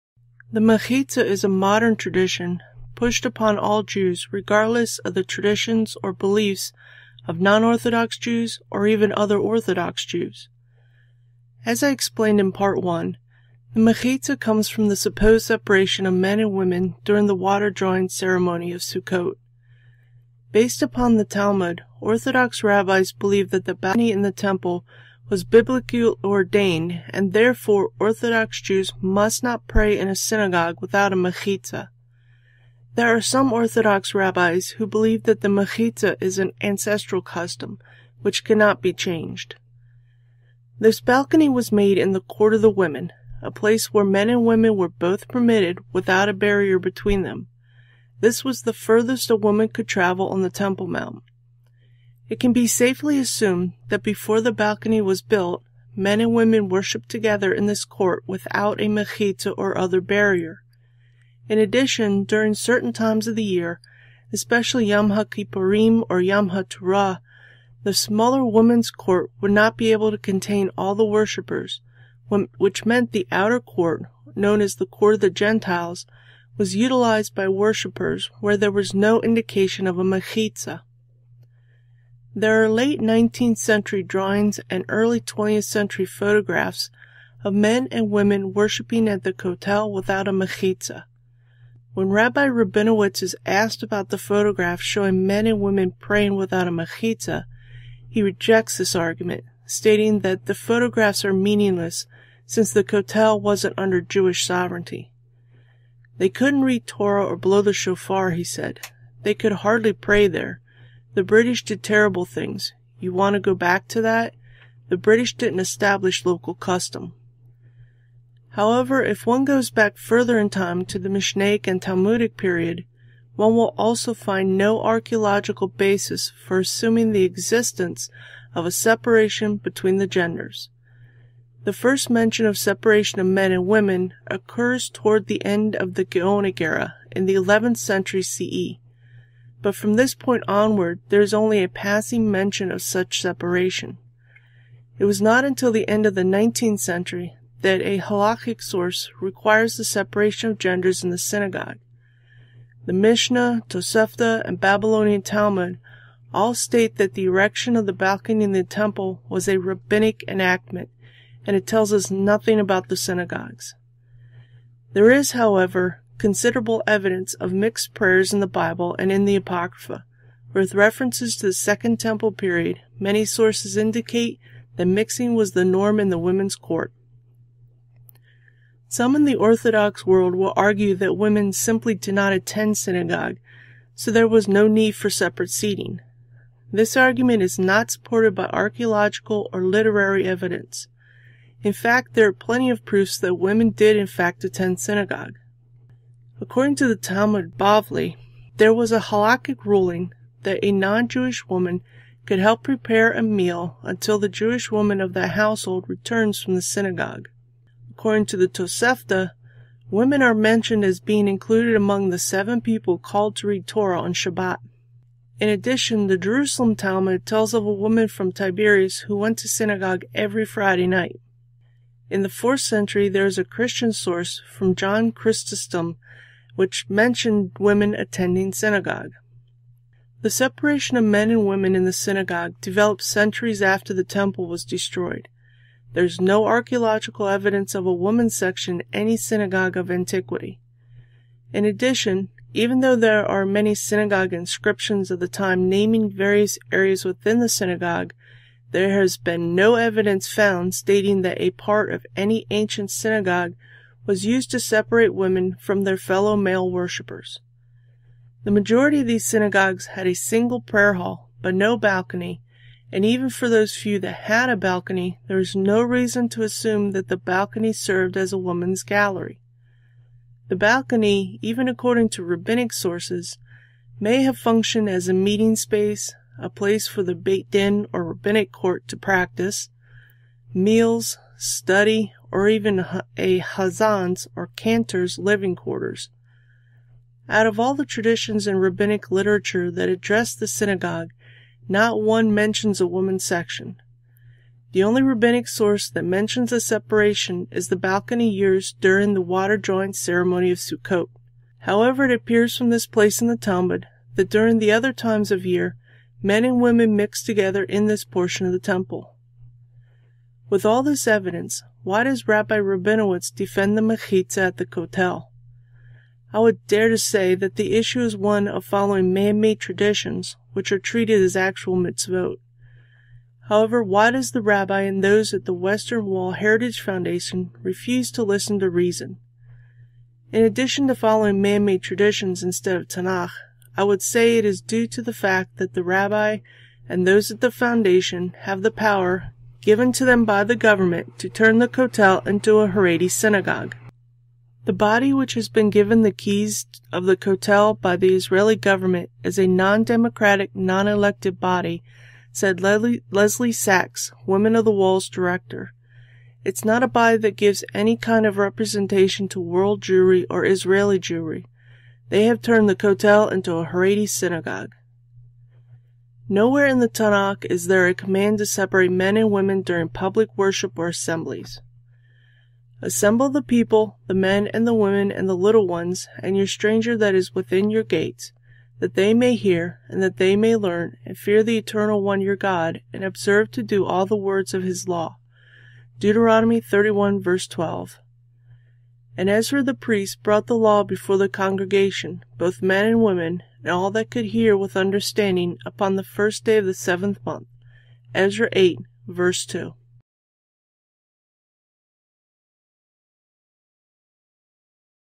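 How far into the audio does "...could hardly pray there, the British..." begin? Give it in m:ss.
1:49.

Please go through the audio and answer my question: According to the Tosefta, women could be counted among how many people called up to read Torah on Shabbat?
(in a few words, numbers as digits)
7.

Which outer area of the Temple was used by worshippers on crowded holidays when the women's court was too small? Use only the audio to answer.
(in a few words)
court of the Gentiles.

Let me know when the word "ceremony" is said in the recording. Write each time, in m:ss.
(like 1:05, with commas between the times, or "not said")
0:18, 4:59.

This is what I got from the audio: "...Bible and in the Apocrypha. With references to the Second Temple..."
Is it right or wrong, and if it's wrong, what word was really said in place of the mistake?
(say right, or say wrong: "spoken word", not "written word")
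right.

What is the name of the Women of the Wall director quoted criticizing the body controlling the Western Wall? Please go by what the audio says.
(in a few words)
Lesley Sachs.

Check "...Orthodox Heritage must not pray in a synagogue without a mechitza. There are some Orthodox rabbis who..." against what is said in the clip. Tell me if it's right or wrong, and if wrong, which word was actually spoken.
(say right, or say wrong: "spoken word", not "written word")
wrong: "Jews", not "Heritage".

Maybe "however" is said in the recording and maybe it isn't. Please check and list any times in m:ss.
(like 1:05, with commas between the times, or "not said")
1:58, 2:45, 5:01, 5:23.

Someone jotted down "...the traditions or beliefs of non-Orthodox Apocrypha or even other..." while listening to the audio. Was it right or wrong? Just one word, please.
wrong.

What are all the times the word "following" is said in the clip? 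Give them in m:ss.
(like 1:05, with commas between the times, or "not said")
5:18, 5:30.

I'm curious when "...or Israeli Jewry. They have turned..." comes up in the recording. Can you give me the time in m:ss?
6:00.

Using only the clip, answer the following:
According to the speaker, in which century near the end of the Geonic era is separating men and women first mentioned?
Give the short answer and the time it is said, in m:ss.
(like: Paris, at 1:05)
11th century, at 2:17.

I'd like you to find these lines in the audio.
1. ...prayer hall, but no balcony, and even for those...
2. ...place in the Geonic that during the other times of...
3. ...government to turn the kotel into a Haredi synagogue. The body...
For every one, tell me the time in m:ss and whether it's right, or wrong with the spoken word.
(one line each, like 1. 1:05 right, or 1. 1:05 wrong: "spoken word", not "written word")
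1. 4:20 right
2. 5:02 wrong: "Talmud", not "Geonic"
3. 5:40 right.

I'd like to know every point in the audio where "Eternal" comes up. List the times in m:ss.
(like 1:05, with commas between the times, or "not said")
6:21.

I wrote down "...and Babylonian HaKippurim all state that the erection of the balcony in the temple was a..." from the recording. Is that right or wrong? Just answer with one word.
wrong.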